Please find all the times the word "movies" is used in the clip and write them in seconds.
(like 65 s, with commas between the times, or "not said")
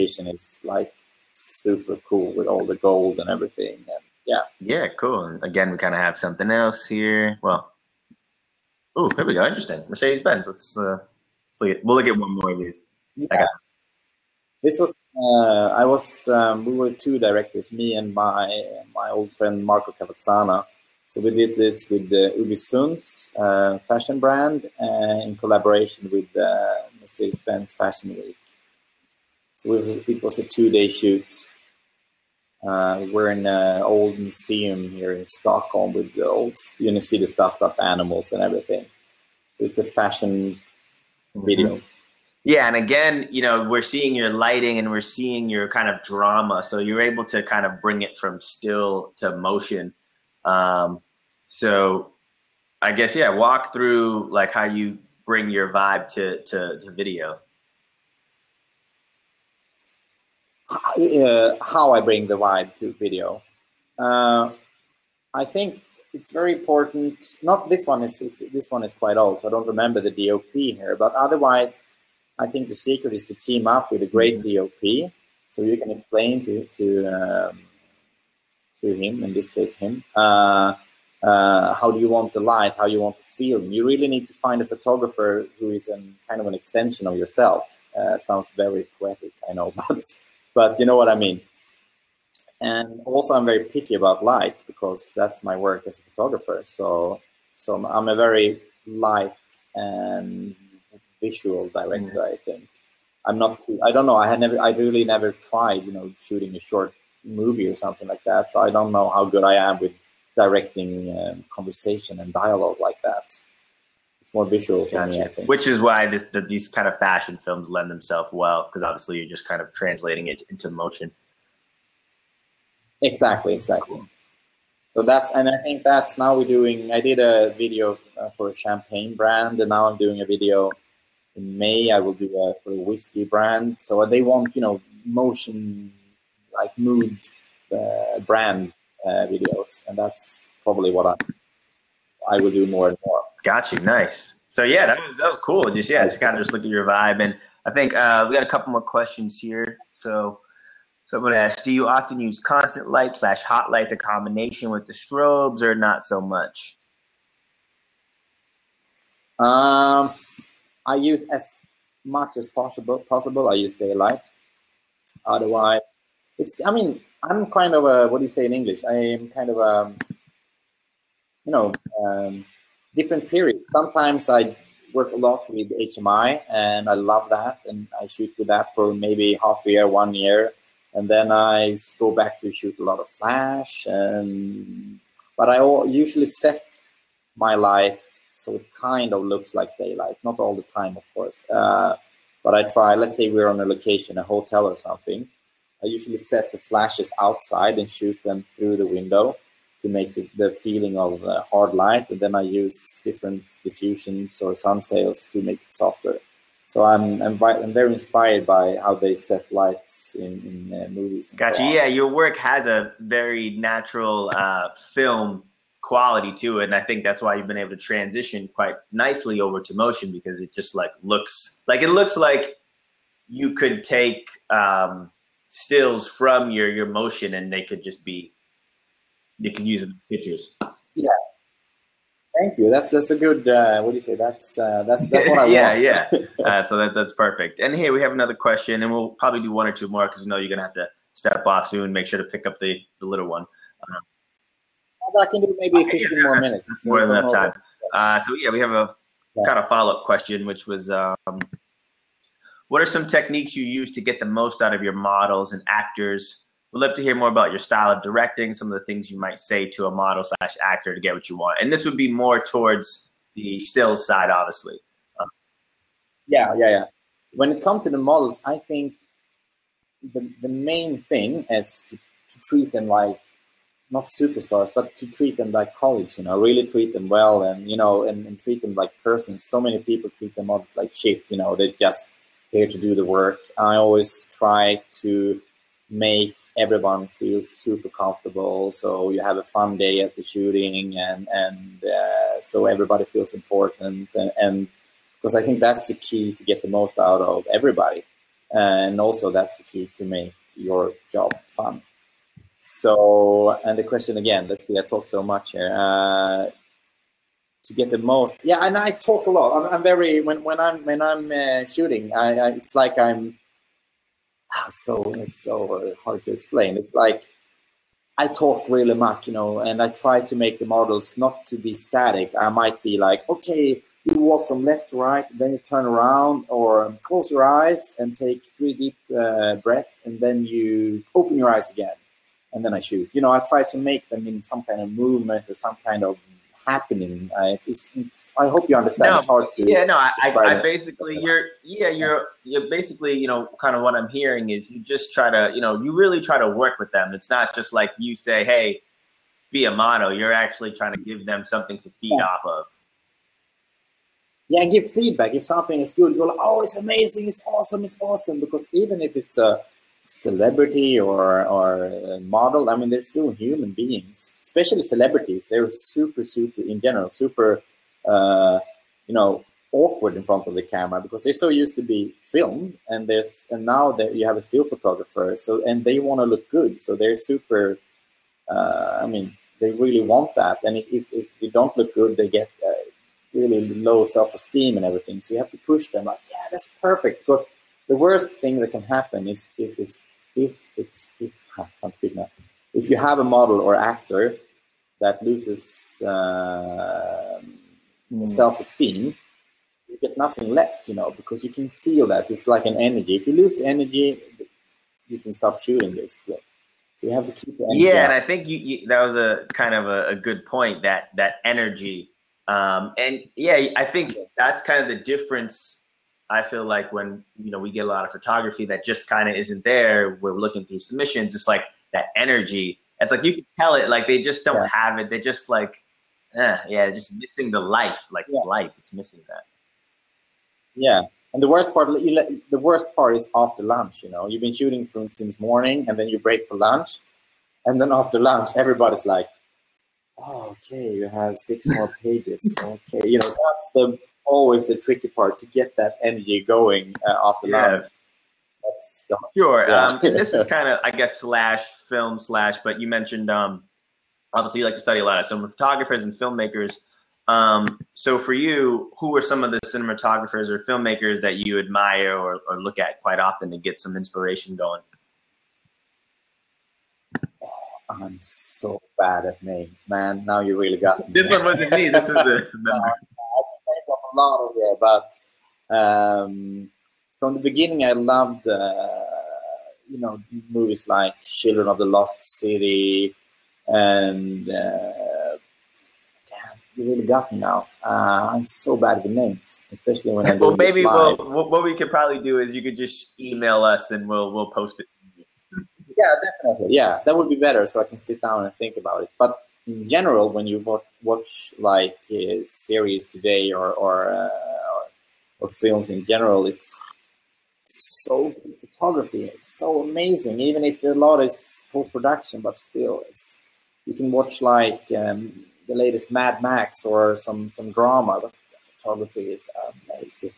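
107 s, 210 s, 480 s.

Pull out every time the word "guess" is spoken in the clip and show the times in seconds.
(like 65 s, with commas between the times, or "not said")
52 s, 450 s.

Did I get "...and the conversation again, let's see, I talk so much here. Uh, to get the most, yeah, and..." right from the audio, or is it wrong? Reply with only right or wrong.
wrong.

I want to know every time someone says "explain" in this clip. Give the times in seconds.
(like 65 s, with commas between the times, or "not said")
75 s, 316 s.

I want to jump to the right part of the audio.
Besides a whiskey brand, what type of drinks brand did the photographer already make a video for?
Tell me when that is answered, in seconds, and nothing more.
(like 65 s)
128 s.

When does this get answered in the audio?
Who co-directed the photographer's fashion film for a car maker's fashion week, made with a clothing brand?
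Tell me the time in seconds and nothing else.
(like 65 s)
19 s.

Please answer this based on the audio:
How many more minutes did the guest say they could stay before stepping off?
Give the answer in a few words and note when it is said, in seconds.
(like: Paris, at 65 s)
15, at 245 s.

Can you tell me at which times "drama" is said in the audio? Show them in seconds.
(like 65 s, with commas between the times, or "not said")
46 s, 517 s.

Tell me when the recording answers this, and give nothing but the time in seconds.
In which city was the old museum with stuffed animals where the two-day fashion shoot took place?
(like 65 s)
35 s.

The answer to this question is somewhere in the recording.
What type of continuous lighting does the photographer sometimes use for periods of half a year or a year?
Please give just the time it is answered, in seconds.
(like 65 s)
175 s.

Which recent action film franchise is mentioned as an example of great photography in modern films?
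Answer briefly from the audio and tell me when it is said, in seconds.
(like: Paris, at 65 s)
Mad Max, at 516 s.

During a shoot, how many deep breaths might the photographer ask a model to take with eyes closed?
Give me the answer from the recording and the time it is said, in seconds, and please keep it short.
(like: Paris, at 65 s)
3, at 328 s.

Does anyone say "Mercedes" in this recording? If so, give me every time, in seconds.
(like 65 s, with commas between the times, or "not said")
9 s, 27 s.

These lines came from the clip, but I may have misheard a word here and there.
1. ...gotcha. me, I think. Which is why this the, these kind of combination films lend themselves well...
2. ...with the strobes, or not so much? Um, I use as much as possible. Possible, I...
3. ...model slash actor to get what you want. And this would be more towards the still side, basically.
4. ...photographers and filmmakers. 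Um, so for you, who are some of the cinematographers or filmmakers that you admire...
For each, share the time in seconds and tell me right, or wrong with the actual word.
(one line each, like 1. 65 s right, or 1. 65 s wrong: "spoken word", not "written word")
1. 114 s wrong: "fashion", not "combination"
2. 154 s right
3. 259 s wrong: "obviously", not "basically"
4. 455 s right.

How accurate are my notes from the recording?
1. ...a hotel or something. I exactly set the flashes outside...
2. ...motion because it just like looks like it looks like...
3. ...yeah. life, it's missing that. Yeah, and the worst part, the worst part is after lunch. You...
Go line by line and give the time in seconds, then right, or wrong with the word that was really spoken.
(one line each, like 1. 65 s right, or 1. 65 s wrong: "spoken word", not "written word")
1. 194 s wrong: "usually", not "exactly"
2. 219 s right
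3. 428 s right.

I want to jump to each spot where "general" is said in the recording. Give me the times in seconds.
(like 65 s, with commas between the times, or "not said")
366 s, 499 s, 506 s.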